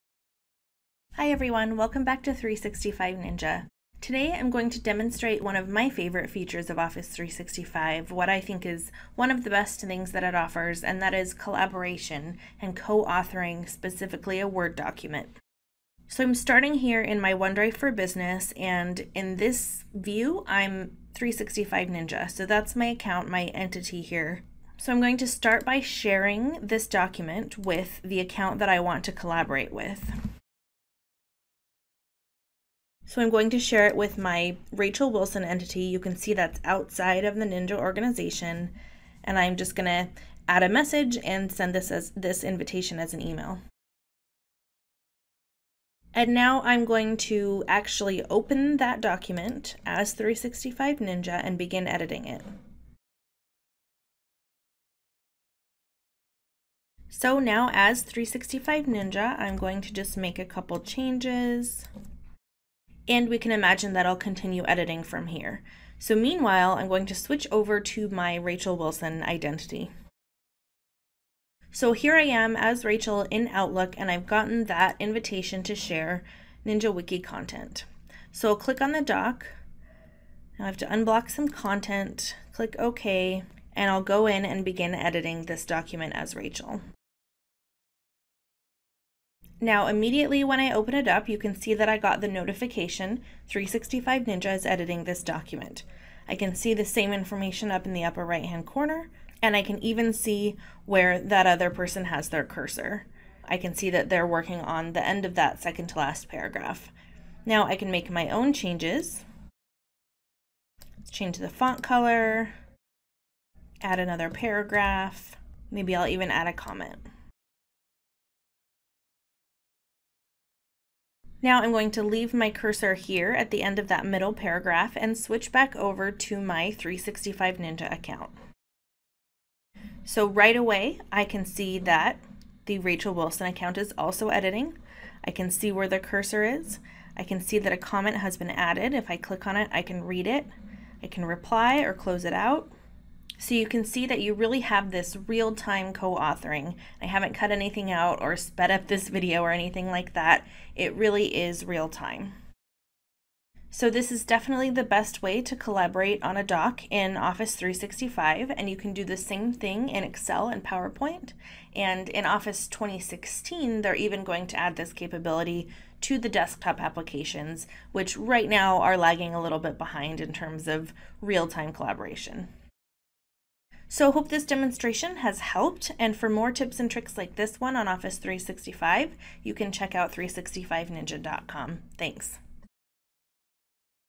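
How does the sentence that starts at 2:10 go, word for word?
So right away, I can see that the Rachel Wilson account is also editing.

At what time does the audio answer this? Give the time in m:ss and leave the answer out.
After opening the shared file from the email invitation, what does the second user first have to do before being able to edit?
1:20.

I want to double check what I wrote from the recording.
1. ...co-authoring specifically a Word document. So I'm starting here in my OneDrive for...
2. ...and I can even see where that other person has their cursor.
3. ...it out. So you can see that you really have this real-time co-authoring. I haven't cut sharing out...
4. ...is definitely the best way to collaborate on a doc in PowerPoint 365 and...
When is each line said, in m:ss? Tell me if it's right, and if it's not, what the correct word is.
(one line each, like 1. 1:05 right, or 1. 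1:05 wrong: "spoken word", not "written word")
1. 0:12 right
2. 1:39 right
3. 2:22 wrong: "anything", not "sharing"
4. 2:34 wrong: "Office", not "PowerPoint".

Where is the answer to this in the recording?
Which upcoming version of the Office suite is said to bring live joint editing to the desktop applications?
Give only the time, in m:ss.
2:42.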